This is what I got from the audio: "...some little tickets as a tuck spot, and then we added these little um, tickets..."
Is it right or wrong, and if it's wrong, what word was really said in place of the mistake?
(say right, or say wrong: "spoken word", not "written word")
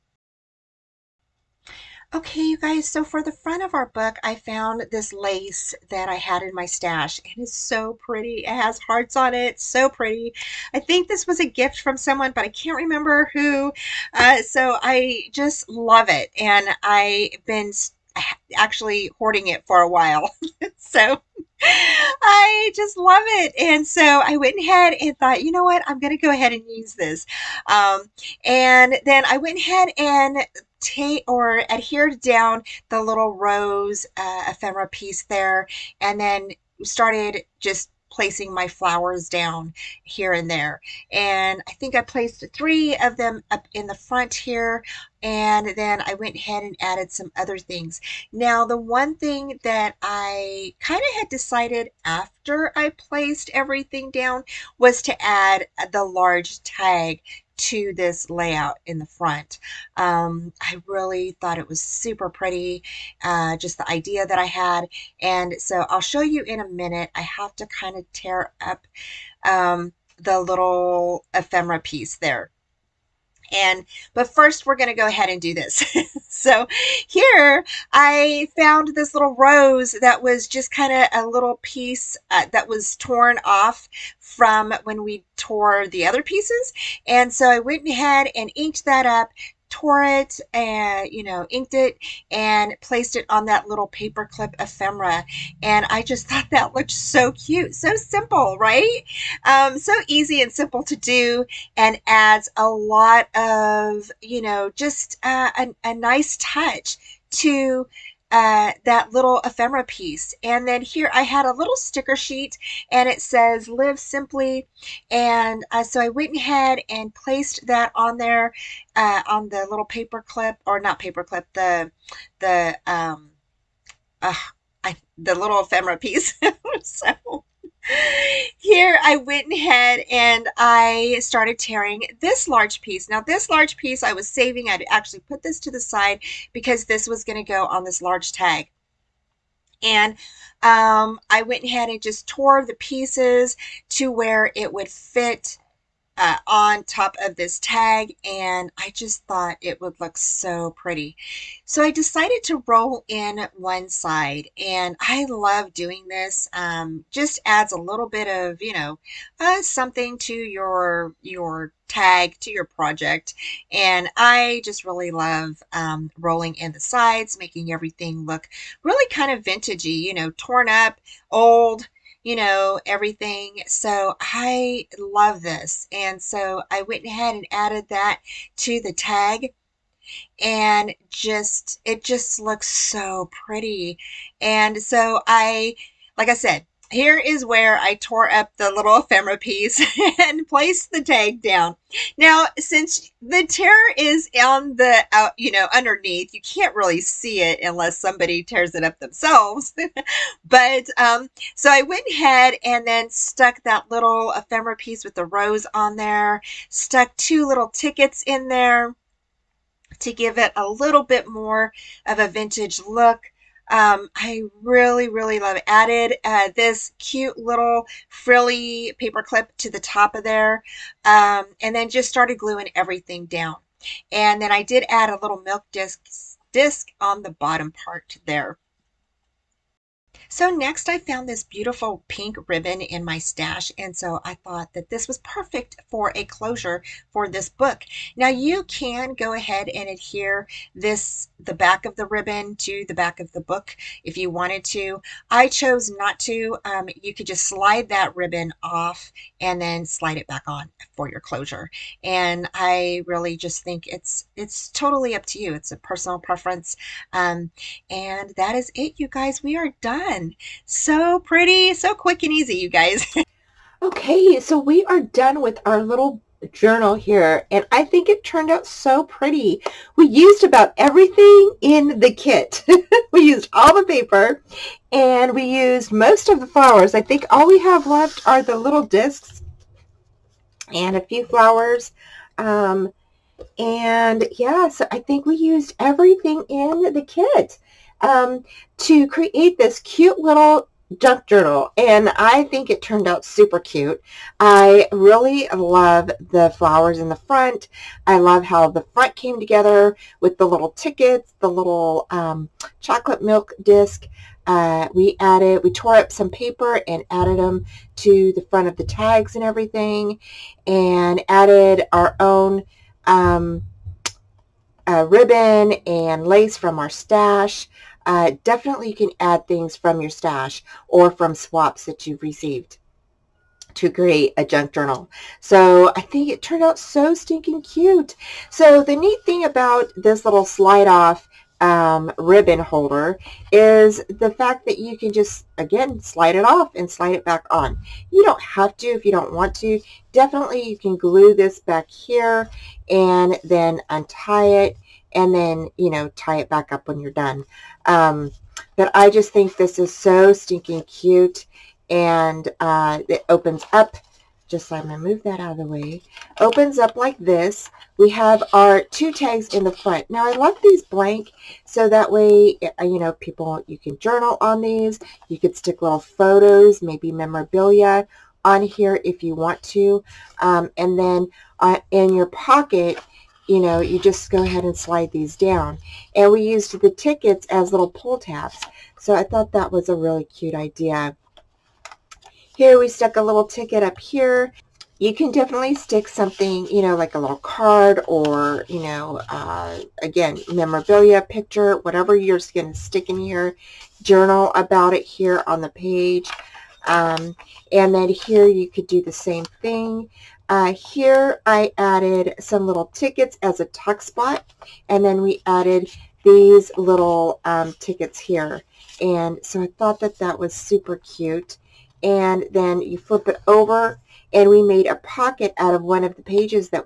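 right.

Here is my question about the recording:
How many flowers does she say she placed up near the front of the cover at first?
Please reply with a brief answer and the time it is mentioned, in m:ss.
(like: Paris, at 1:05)
3, at 0:42.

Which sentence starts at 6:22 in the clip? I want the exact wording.
Here we stuck a little ticket up here.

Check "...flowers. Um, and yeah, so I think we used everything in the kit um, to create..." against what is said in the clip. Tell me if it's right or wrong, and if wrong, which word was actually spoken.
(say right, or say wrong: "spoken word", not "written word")
right.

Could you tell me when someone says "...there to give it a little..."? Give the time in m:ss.
3:28.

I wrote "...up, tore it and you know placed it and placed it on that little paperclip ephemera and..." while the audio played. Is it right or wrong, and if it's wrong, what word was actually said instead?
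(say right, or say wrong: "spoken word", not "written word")
wrong: "inked", not "placed".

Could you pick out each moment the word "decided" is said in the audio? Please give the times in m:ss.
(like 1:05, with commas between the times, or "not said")
0:51, 2:31.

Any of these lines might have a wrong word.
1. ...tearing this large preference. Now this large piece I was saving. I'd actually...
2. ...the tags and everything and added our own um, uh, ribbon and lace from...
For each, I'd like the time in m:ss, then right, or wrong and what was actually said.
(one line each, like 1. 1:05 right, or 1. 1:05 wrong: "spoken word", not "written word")
1. 2:11 wrong: "piece", not "preference"
2. 5:08 right.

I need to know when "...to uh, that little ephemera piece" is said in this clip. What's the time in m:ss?
1:47.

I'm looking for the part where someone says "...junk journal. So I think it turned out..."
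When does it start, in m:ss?
5:24.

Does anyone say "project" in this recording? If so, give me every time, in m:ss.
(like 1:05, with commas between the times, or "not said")
2:42.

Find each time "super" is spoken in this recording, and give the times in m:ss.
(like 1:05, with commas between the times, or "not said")
1:01, 4:53, 6:50.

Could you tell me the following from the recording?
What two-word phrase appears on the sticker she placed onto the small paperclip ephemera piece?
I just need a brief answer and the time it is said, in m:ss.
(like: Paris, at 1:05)
Live simply, at 1:53.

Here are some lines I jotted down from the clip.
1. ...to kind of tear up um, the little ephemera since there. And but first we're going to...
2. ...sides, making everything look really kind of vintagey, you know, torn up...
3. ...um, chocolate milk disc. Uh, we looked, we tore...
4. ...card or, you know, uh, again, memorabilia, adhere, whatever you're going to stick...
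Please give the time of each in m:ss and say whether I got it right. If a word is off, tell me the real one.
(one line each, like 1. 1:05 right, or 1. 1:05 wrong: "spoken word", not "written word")
1. 1:07 wrong: "piece", not "since"
2. 2:46 right
3. 5:02 wrong: "added", not "looked"
4. 6:27 wrong: "picture", not "adhere".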